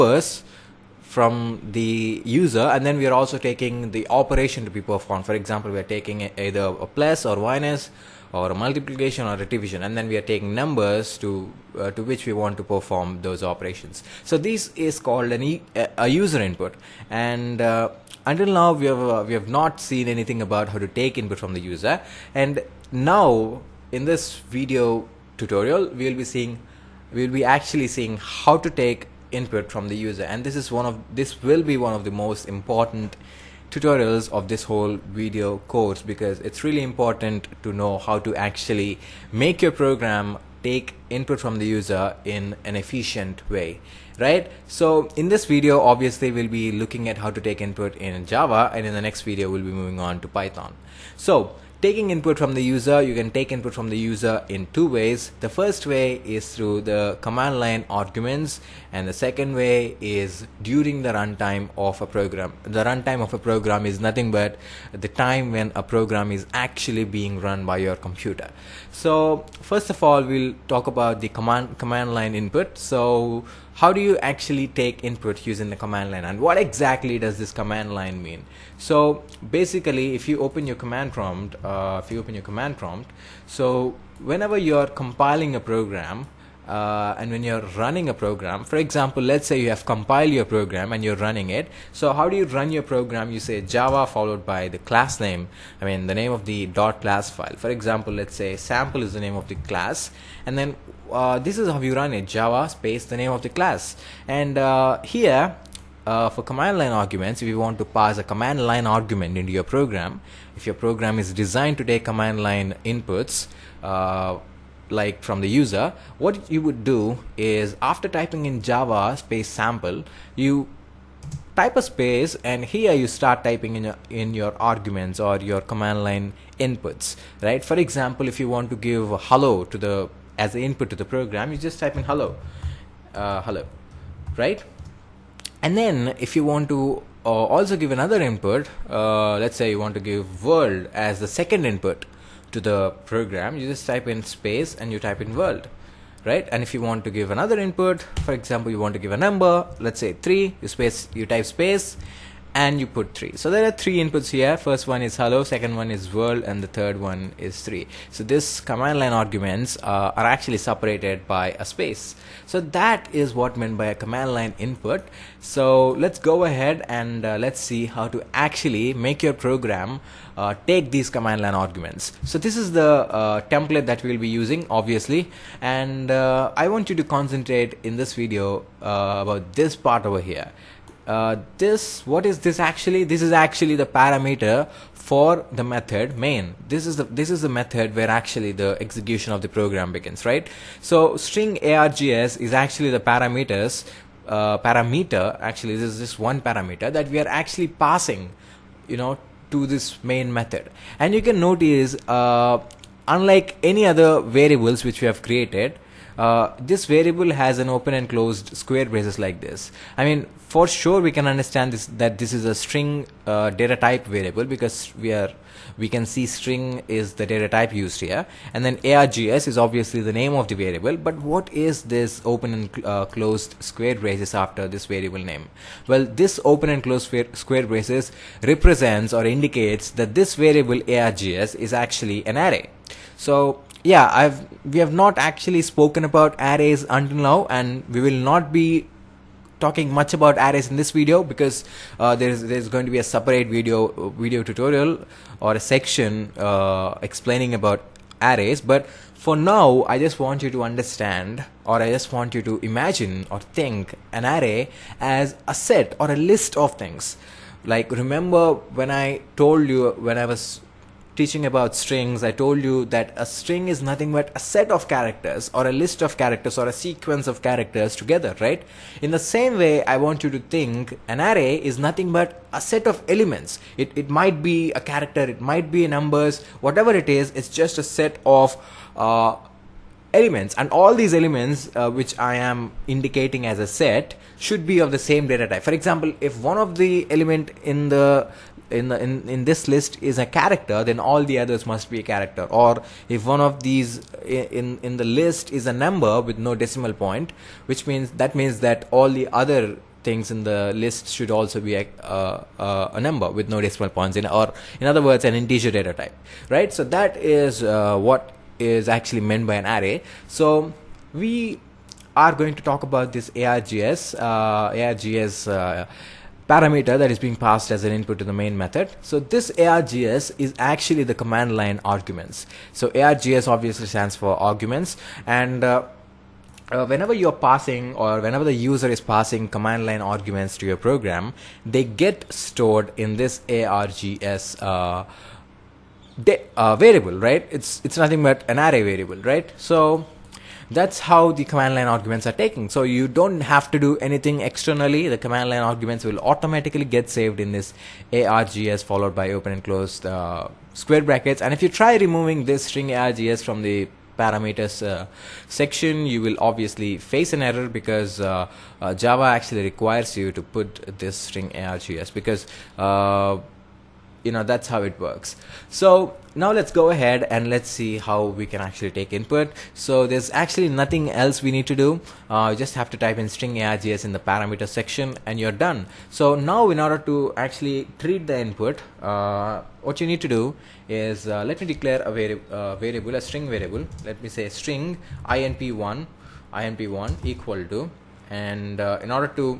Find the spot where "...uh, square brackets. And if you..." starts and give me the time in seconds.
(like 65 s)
350 s.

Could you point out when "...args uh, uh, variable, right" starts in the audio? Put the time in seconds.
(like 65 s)
333 s.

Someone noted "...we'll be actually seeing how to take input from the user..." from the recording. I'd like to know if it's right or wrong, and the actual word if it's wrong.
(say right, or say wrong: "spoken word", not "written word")
right.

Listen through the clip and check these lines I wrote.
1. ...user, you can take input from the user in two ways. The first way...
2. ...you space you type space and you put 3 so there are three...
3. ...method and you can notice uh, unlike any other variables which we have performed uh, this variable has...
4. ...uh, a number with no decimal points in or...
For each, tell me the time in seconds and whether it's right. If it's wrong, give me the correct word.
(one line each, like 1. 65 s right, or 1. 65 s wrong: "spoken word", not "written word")
1. 52 s right
2. 150 s right
3. 200 s wrong: "created", not "performed"
4. 302 s right.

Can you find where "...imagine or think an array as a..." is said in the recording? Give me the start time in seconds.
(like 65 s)
252 s.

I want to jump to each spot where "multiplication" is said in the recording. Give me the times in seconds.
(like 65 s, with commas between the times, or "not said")
8 s.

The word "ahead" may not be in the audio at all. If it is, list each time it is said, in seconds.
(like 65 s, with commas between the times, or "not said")
166 s, 366 s.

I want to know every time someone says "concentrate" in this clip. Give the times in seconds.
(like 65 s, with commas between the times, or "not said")
177 s.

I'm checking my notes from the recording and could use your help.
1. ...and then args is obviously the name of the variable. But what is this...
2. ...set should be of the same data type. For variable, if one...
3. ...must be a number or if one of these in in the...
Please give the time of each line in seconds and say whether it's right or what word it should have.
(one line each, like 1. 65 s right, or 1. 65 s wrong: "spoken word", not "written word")
1. 218 s right
2. 283 s wrong: "example", not "variable"
3. 291 s wrong: "character", not "number".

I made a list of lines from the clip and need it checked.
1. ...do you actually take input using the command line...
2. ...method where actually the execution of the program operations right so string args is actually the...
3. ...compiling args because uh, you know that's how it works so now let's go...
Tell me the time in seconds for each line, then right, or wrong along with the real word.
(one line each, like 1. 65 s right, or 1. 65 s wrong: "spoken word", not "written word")
1. 73 s right
2. 187 s wrong: "begins", not "operations"
3. 361 s wrong: "string", not "compiling".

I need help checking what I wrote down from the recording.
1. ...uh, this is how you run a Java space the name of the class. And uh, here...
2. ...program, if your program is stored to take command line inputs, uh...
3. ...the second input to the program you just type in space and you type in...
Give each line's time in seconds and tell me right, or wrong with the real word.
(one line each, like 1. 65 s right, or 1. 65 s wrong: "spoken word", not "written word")
1. 101 s right
2. 109 s wrong: "designed", not "stored"
3. 141 s right.